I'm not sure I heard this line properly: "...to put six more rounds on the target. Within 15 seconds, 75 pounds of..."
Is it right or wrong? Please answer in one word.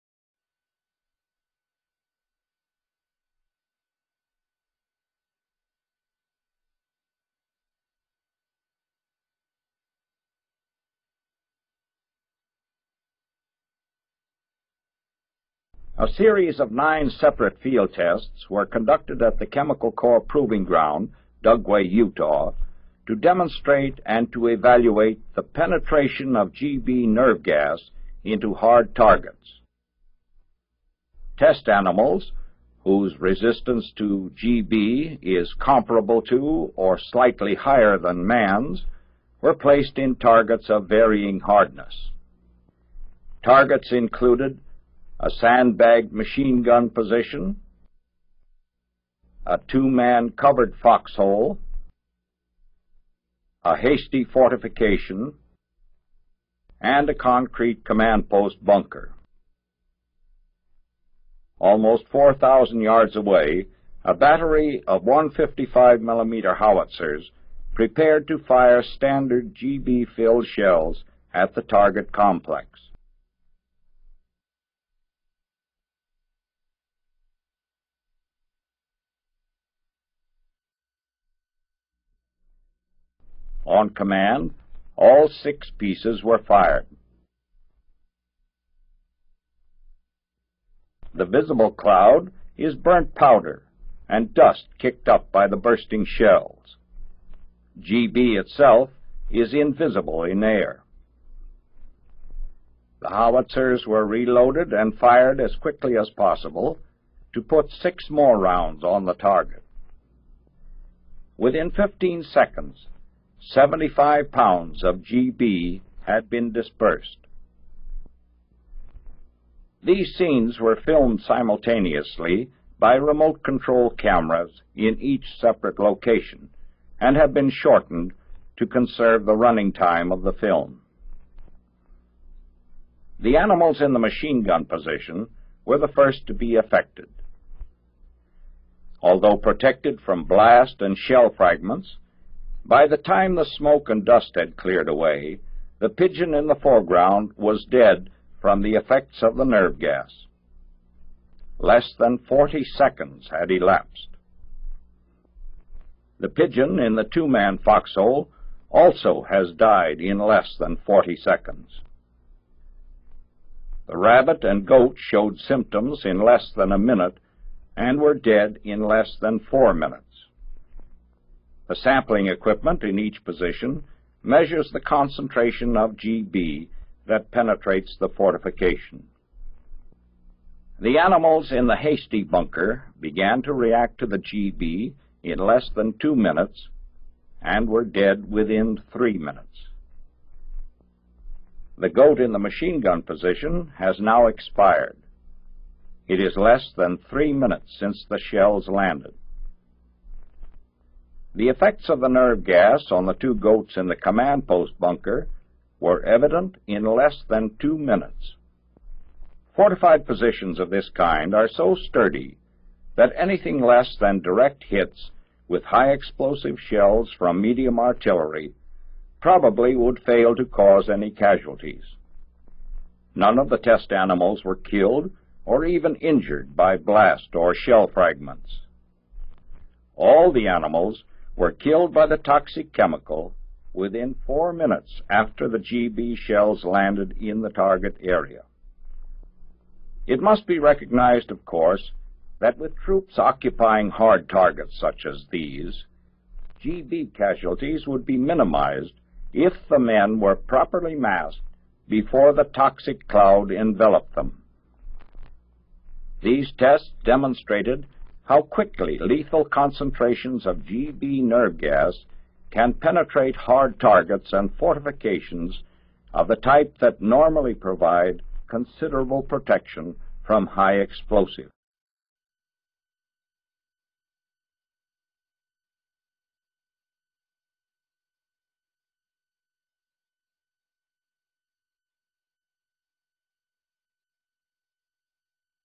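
right.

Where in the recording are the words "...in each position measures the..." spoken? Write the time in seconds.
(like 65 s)
172 s.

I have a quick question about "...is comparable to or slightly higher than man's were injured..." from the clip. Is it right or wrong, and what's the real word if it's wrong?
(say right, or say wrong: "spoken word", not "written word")
wrong: "placed", not "injured".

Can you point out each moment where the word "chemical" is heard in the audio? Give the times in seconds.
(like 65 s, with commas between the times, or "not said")
19 s, 232 s.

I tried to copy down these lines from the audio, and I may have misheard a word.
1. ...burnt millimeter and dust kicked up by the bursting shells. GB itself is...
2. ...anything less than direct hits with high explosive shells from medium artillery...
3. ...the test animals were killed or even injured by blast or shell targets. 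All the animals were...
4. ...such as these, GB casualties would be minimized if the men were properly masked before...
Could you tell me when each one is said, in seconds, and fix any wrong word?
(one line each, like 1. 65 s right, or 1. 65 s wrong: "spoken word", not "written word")
1. 92 s wrong: "powder", not "millimeter"
2. 213 s right
3. 223 s wrong: "fragments", not "targets"
4. 244 s right.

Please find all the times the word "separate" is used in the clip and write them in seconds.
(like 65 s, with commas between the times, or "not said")
17 s, 125 s.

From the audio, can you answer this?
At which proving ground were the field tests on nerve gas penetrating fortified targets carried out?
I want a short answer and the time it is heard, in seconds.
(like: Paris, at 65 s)
Dugway, Utah, at 21 s.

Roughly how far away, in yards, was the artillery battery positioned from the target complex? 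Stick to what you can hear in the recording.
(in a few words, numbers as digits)
4,000 yards.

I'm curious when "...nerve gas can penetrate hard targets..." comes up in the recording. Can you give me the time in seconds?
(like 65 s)
261 s.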